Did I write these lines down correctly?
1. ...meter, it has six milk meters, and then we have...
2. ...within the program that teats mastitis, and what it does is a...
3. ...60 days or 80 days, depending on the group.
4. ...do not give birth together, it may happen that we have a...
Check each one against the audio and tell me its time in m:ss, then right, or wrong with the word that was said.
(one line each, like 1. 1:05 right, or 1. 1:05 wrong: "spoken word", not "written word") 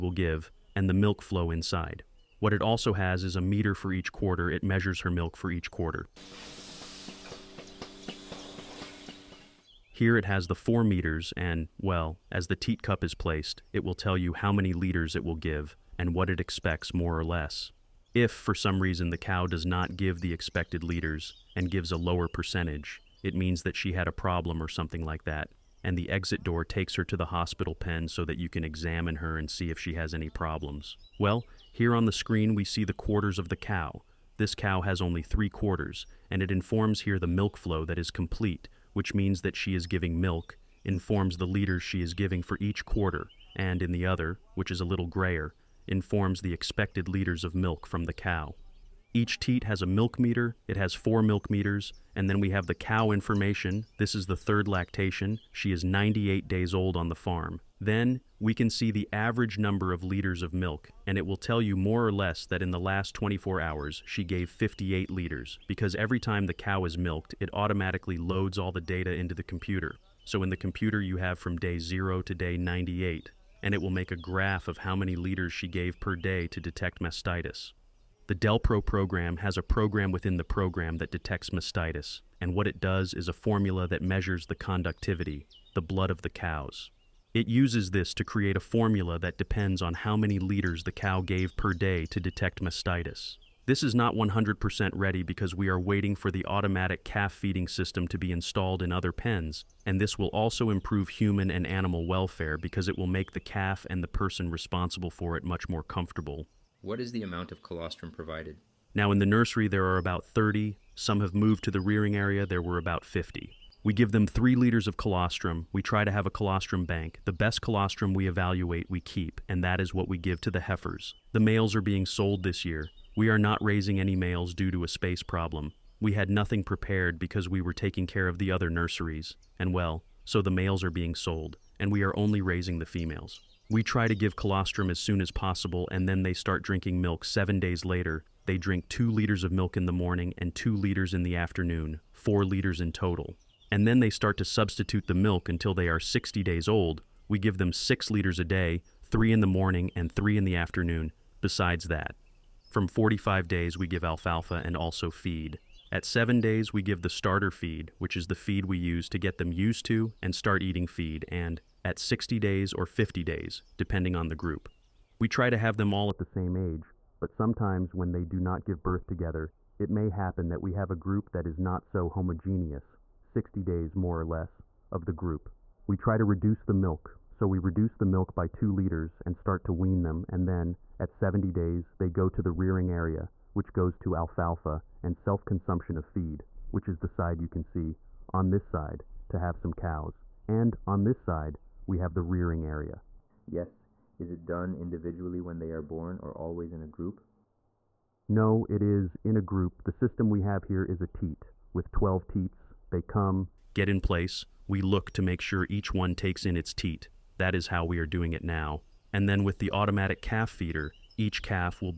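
1. 0:50 wrong: "four", not "six"
2. 1:20 wrong: "detects", not "teats"
3. 2:41 wrong: "50", not "80"
4. 2:48 right.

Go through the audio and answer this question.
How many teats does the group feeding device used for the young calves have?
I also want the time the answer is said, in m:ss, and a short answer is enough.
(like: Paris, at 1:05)
12, at 3:21.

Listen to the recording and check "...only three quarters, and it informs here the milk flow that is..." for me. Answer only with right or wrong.
right.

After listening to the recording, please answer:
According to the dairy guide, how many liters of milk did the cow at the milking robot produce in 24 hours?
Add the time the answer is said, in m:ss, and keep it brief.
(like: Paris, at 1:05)
58 liters, at 1:04.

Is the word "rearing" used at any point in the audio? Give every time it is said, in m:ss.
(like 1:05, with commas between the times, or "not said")
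1:51, 3:02, 3:12.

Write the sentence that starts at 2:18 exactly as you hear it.
They drink two liters of milk in the morning and two liters in the afternoon, four liters in total.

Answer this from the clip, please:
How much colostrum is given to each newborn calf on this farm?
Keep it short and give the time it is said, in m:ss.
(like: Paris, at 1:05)
3 liters, at 1:54.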